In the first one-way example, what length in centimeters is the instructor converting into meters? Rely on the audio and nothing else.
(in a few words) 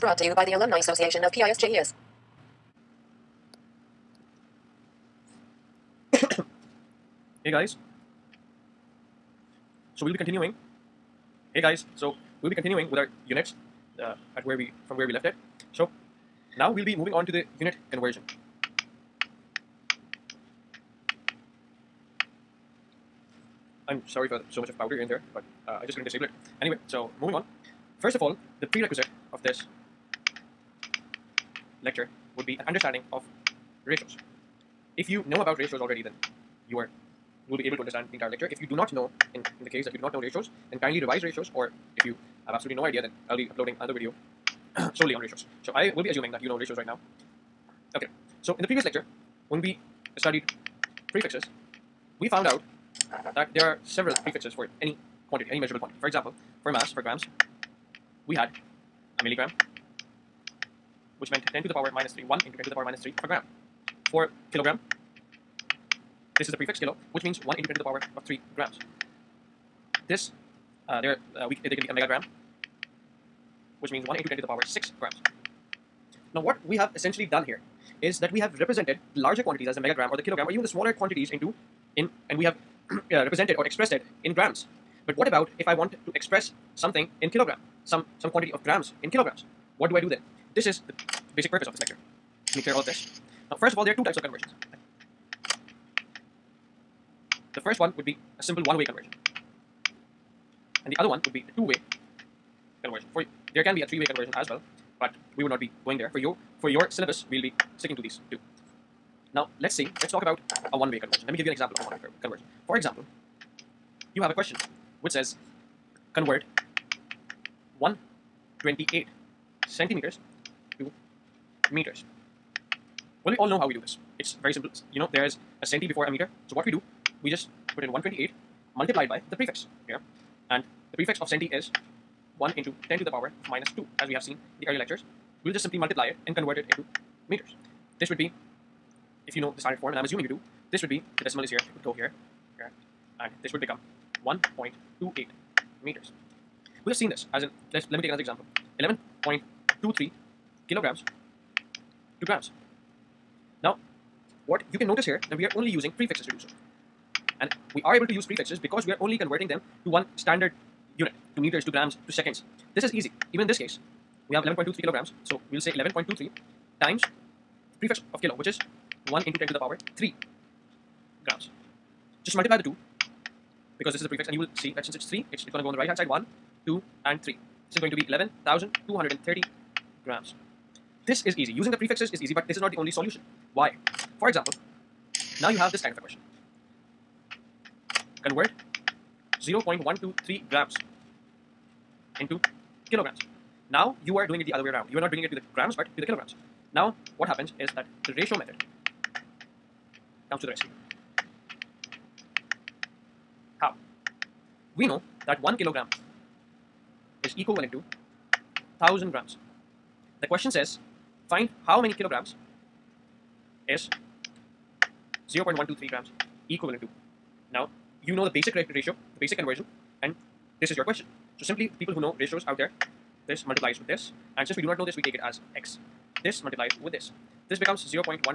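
128 centimeters.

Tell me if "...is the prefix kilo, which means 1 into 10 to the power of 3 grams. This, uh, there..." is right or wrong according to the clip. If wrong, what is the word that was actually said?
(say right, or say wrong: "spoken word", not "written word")
right.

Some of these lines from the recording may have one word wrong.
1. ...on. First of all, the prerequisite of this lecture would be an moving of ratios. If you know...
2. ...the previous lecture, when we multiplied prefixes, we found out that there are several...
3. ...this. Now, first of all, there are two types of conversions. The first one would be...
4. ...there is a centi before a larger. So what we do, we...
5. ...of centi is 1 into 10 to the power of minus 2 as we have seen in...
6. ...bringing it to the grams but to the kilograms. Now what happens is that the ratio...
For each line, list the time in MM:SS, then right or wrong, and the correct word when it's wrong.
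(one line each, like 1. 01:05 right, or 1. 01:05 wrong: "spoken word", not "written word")
1. 00:27 wrong: "understanding", not "moving"
2. 00:48 wrong: "studied", not "multiplied"
3. 01:32 right
4. 02:05 wrong: "meter", not "larger"
5. 02:11 right
6. 03:15 right.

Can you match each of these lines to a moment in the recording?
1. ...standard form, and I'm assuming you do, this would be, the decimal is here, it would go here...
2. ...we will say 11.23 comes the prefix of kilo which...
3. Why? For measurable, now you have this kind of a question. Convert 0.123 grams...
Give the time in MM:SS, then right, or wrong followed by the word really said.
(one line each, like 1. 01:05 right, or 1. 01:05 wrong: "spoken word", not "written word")
1. 02:19 right
2. 02:45 wrong: "times", not "comes"
3. 03:03 wrong: "example", not "measurable".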